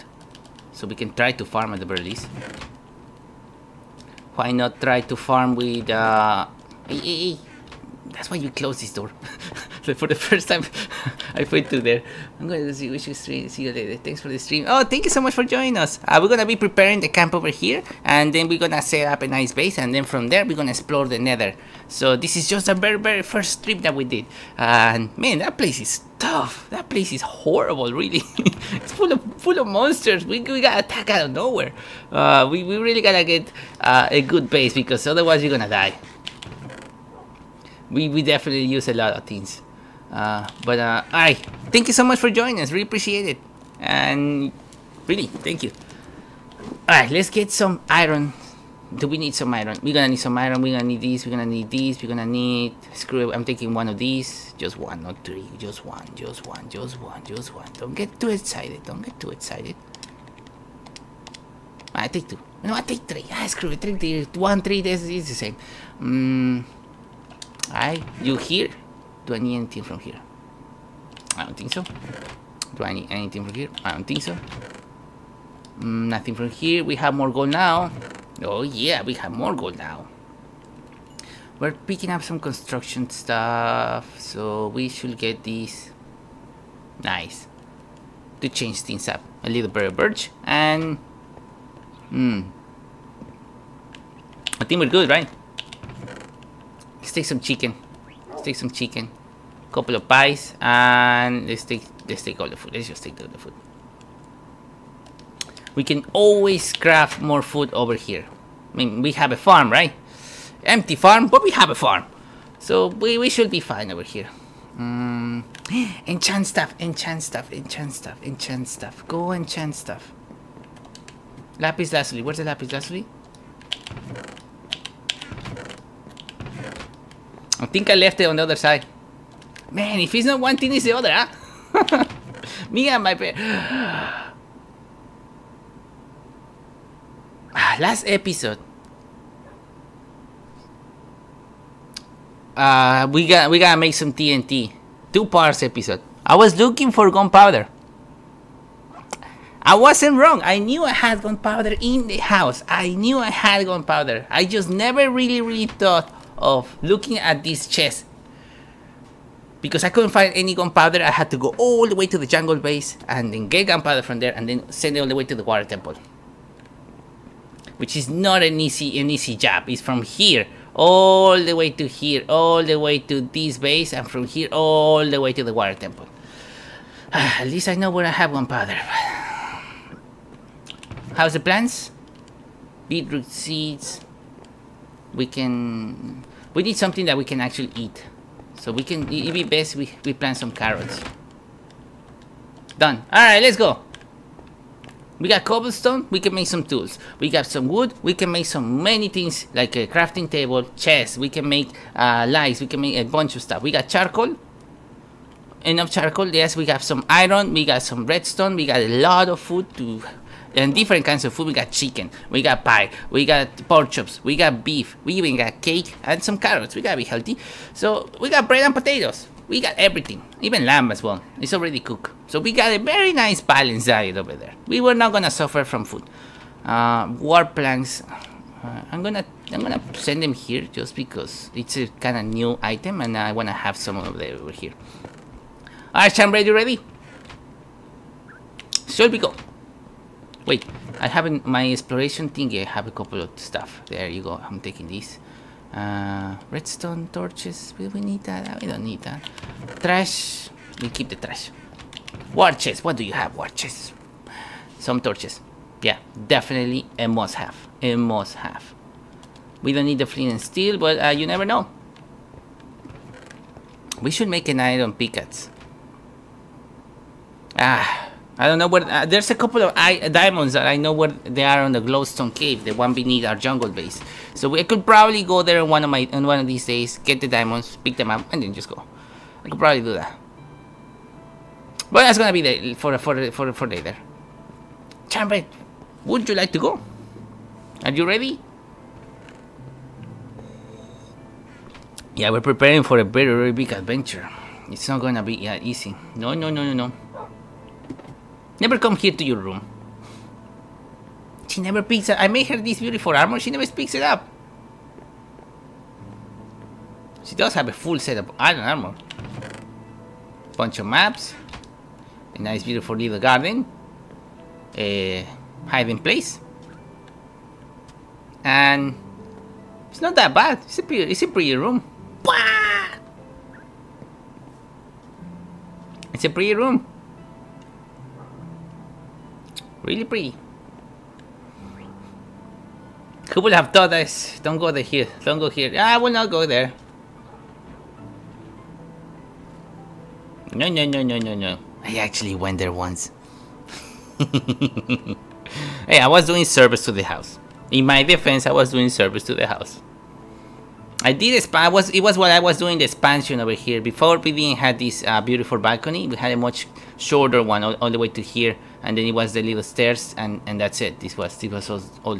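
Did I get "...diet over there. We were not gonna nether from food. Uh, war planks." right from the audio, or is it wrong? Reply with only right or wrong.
wrong.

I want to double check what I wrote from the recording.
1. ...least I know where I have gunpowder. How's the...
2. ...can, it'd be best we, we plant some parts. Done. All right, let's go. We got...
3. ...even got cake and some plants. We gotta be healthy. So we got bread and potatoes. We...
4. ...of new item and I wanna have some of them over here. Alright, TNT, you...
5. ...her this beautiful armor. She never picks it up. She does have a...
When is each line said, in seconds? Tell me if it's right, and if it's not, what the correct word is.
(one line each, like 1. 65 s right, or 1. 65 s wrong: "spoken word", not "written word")
1. 177 s right
2. 188 s wrong: "carrots", not "parts"
3. 215 s wrong: "carrots", not "plants"
4. 232 s wrong: "Chamber", not "TNT"
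5. 302 s right.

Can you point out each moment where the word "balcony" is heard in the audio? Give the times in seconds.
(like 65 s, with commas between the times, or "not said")
355 s.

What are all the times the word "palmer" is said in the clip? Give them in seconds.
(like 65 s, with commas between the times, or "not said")
not said.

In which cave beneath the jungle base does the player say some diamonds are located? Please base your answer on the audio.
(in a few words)
The glowstone cave.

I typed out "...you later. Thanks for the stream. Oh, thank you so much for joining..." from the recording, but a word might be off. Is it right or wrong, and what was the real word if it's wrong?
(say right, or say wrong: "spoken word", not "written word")
right.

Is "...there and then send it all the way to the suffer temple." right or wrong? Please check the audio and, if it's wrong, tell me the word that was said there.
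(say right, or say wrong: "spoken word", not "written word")
wrong: "water", not "suffer".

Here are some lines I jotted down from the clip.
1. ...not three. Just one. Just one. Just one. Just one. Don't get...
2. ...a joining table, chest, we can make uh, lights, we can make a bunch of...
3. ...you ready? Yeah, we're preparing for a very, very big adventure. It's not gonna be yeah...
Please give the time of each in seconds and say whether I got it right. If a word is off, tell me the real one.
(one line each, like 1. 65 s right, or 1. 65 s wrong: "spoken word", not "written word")
1. 55 s right
2. 199 s wrong: "crafting", not "joining"
3. 287 s right.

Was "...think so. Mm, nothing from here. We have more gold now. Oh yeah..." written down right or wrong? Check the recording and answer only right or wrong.
right.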